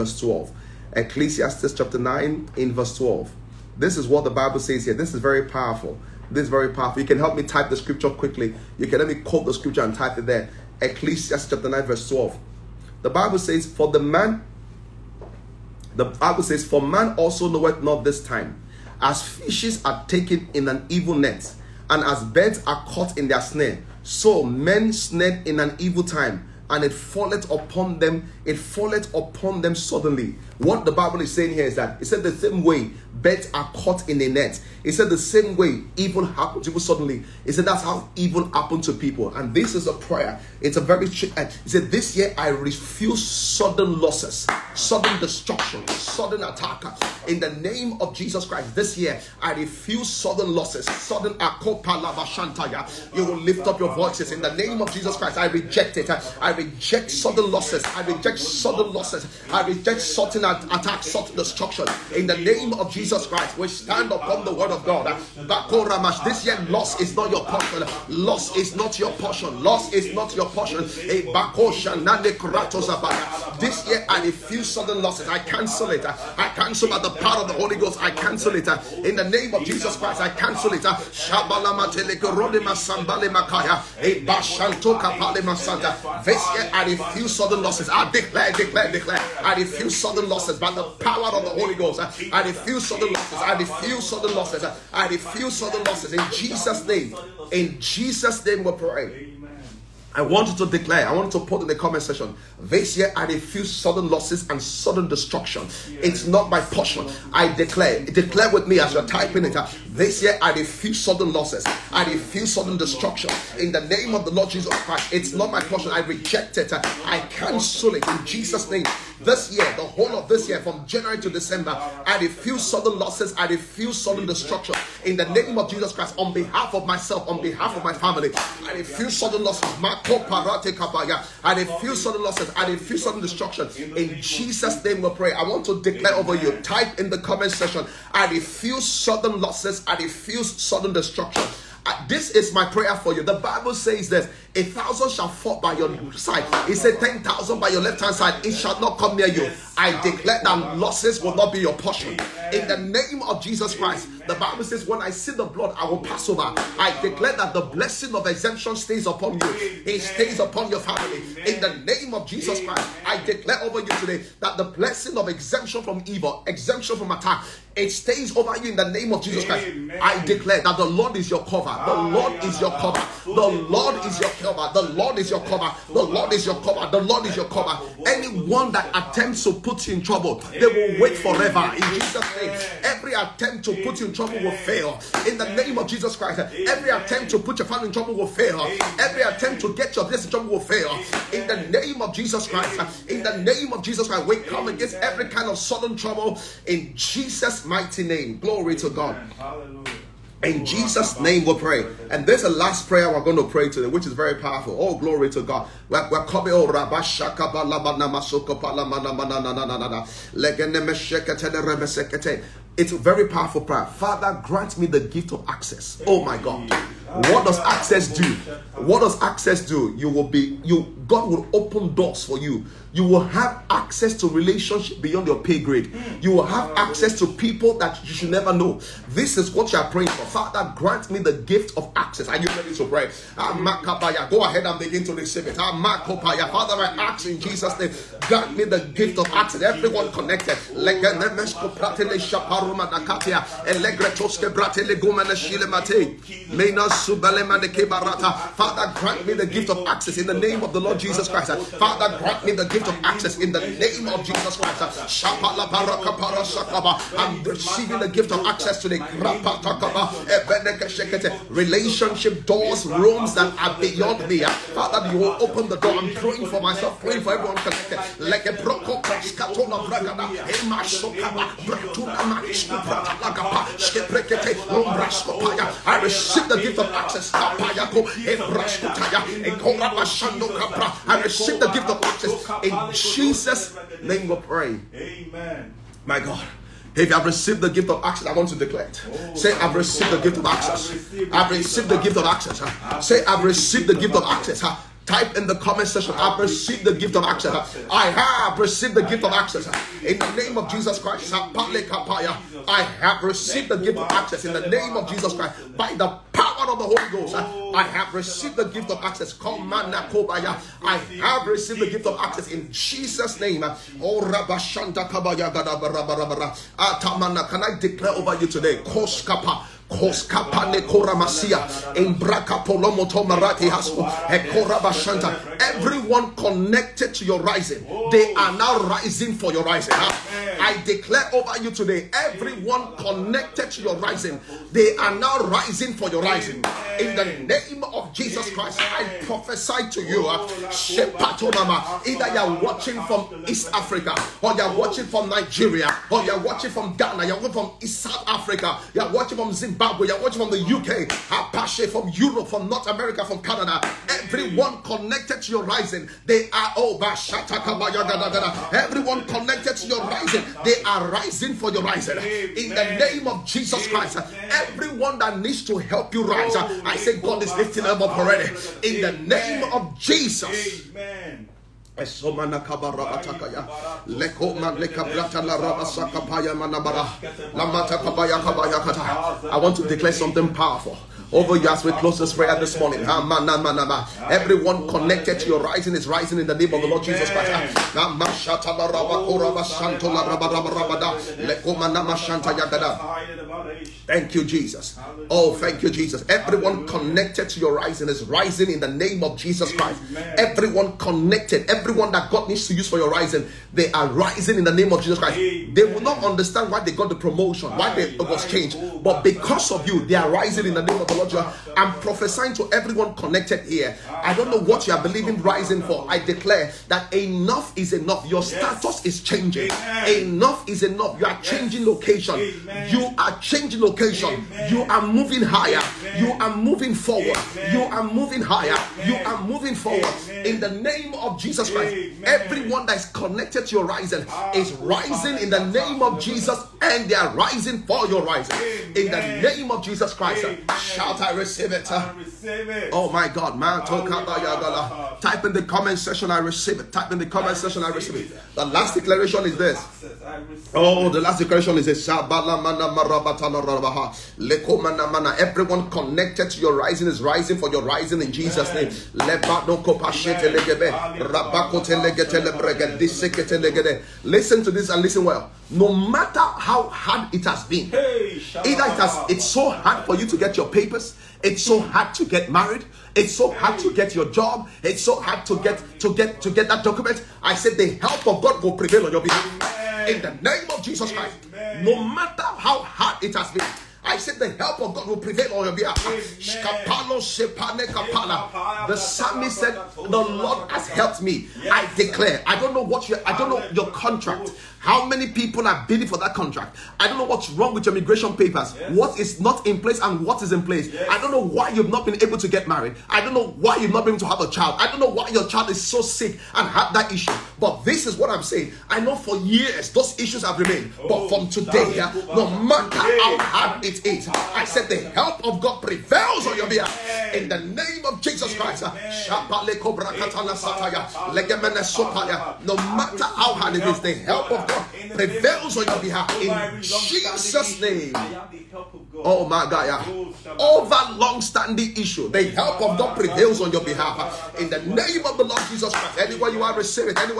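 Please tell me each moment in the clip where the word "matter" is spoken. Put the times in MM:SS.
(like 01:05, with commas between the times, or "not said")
07:45, 08:02, 08:32, 08:42.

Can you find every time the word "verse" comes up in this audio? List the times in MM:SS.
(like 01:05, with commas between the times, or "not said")
00:02, 00:11.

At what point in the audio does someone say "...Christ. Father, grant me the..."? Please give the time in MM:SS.
04:11.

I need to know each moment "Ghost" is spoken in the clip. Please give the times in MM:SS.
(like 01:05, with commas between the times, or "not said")
01:17, 01:31, 05:07.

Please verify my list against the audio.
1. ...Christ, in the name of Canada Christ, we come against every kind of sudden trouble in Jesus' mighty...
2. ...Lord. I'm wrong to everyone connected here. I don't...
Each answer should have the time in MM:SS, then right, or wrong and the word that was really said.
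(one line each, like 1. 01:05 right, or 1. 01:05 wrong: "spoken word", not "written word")
1. 03:12 wrong: "Jesus", not "Canada"
2. 06:51 wrong: "prophesying", not "wrong".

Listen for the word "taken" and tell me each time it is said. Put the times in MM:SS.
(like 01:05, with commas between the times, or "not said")
00:20.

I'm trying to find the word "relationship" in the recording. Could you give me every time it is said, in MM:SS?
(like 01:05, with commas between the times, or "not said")
03:44, 04:21.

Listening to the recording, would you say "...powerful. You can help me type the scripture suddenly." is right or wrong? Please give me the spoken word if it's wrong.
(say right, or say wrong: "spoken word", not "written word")
wrong: "quickly", not "suddenly".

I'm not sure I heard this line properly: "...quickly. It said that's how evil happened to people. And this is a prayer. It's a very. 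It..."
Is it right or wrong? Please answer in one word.
wrong.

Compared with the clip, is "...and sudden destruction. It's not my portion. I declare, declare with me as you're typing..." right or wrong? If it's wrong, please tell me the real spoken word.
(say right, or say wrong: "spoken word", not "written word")
right.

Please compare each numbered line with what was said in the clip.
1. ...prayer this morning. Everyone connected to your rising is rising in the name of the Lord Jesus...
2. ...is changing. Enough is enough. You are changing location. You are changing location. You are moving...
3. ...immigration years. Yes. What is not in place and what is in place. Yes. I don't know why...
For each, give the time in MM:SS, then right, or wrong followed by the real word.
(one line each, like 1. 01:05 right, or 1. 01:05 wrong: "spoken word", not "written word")
1. 06:22 right
2. 06:59 right
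3. 08:17 wrong: "papers", not "years".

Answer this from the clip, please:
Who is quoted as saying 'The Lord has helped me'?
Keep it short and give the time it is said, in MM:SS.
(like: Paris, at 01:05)
The psalmist, at 08:08.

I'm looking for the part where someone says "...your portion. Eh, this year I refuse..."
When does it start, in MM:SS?
01:10.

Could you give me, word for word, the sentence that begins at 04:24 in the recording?
Father, you will open the door.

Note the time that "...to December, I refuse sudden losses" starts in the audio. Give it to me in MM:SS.
02:01.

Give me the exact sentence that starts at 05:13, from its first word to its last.
Oh, ah, can I declare over you today?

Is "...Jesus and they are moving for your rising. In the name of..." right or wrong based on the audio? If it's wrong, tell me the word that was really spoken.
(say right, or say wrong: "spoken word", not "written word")
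wrong: "rising", not "moving".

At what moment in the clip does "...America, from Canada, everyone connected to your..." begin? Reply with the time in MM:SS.
05:52.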